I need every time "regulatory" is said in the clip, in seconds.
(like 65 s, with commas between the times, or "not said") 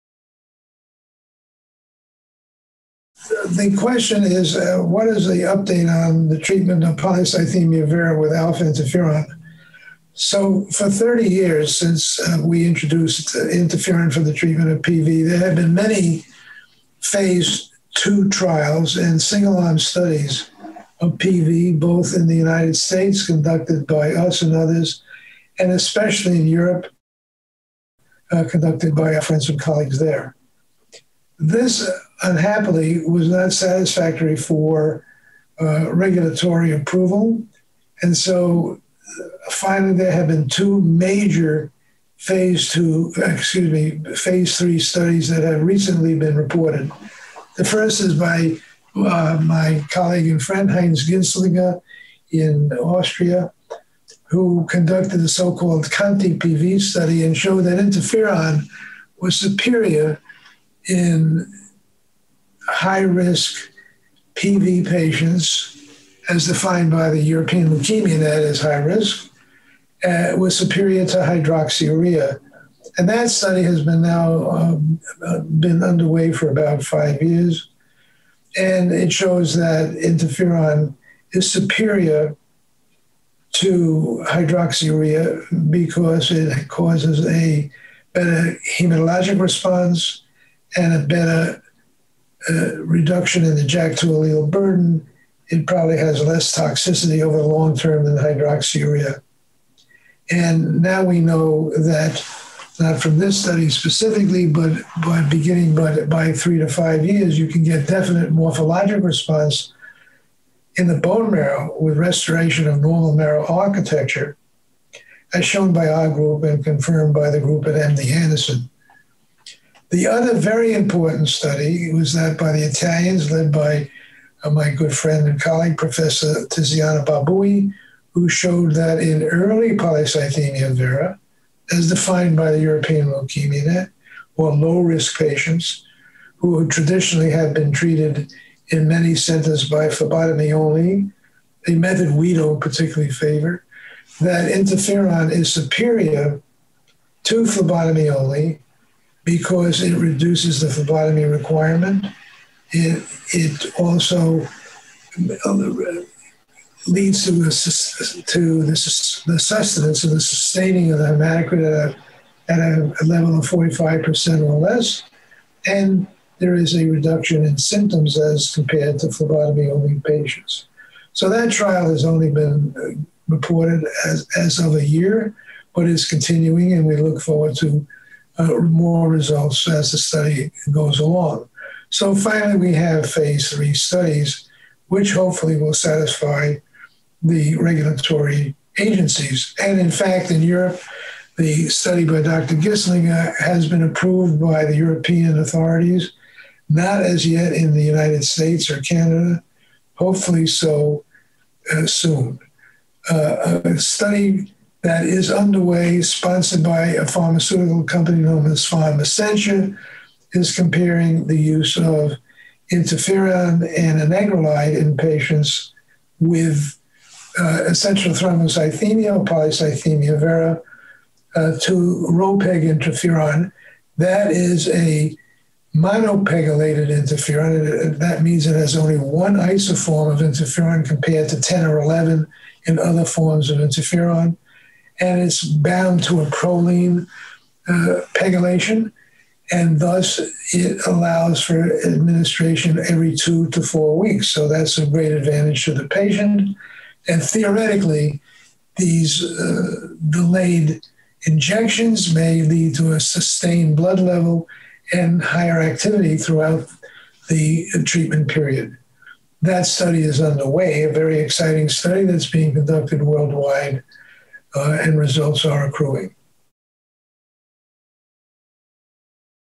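35 s, 187 s.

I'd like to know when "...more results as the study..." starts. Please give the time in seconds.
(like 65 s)
178 s.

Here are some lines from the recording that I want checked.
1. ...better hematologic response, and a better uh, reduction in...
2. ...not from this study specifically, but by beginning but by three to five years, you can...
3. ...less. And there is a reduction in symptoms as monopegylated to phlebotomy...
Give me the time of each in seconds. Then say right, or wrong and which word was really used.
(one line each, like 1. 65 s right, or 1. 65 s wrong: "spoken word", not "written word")
1. 88 s right
2. 102 s right
3. 164 s wrong: "compared", not "monopegylated".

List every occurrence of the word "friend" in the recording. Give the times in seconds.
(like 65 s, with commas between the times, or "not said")
29 s, 50 s, 124 s.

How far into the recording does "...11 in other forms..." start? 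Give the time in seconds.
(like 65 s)
231 s.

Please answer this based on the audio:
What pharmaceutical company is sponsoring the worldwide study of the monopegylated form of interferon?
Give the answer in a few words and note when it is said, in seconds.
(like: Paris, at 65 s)
PharmaEssentia, at 208 s.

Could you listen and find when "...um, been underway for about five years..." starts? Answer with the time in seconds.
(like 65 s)
74 s.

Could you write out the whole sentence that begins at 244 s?
So that's a great advantage to the patient.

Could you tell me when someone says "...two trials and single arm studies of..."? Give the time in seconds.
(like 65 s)
17 s.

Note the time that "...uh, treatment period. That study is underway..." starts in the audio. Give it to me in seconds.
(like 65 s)
257 s.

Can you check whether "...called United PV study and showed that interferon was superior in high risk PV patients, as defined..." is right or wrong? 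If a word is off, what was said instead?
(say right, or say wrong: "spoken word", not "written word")
wrong: "Conti", not "United".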